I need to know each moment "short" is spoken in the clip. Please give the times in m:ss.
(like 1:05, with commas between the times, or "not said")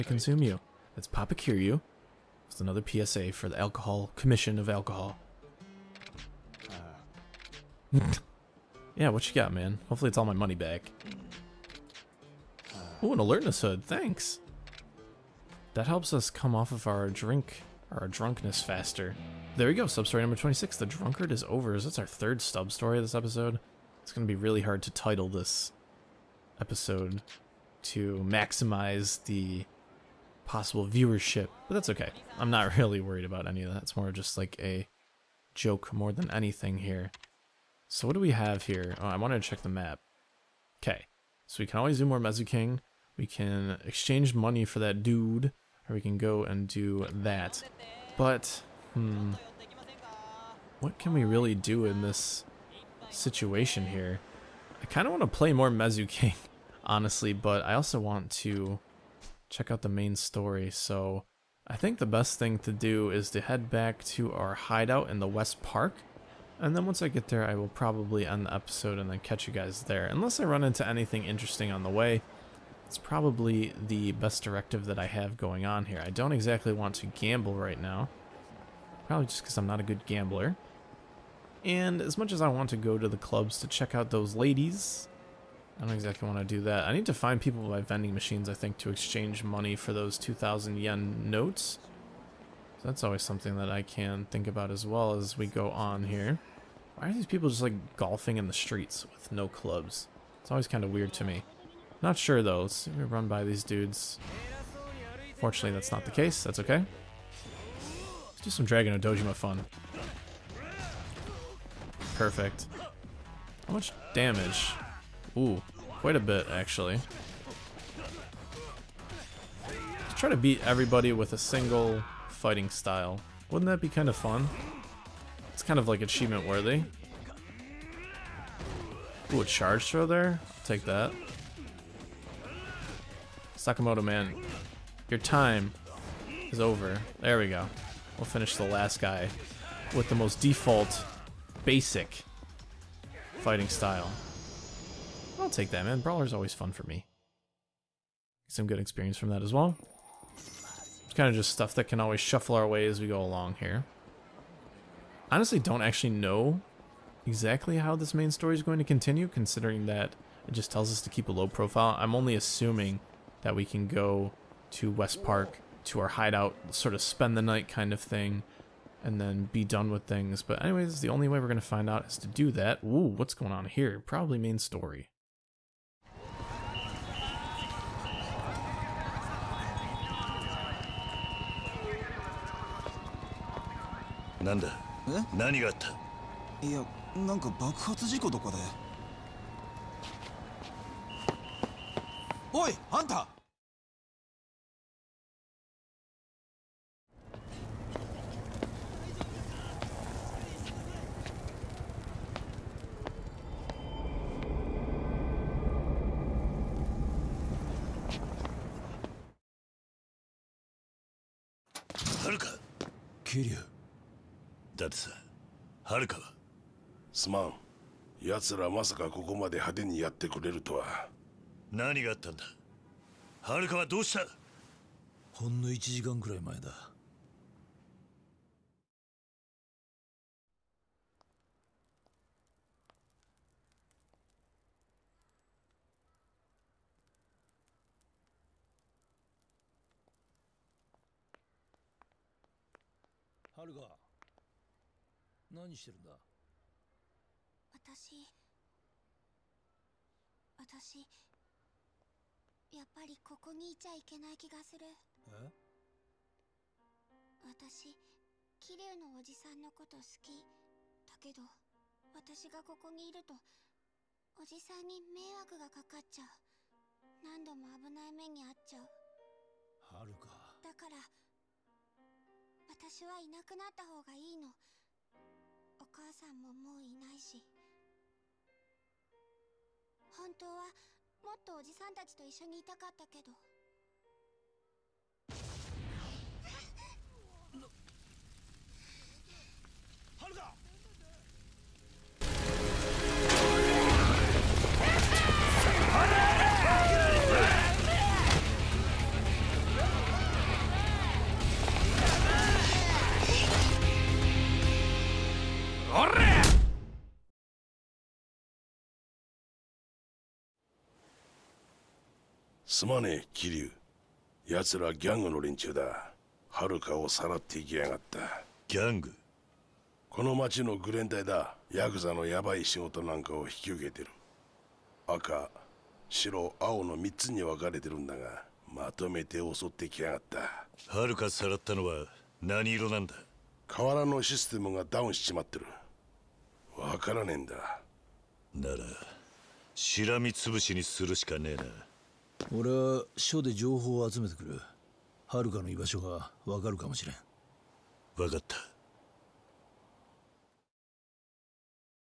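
not said.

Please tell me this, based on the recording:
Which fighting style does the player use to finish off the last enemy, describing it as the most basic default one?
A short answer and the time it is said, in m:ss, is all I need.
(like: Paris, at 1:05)
Brawler, at 2:26.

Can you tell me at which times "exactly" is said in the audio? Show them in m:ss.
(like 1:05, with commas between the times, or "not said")
1:16, 1:25, 2:37.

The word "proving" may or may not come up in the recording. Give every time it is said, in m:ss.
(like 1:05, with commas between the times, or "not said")
not said.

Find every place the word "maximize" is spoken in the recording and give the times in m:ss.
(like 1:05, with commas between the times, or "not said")
0:28.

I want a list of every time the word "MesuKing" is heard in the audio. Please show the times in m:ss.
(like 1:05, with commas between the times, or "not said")
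0:42, 0:55.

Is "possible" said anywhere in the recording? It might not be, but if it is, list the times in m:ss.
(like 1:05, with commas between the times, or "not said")
0:30.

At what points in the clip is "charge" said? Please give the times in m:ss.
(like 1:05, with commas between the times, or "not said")
2:09.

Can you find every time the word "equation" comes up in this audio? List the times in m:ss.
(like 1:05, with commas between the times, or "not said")
not said.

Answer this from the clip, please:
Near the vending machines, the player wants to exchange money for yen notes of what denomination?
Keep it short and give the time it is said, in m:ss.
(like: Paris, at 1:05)
2,000, at 1:30.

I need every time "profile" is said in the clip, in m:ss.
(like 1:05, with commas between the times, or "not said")
2:41.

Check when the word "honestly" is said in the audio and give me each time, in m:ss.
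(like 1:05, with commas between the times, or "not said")
0:56, 2:35.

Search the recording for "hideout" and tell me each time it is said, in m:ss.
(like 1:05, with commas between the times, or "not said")
1:04, 2:46.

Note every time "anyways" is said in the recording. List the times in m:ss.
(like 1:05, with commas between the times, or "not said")
2:50.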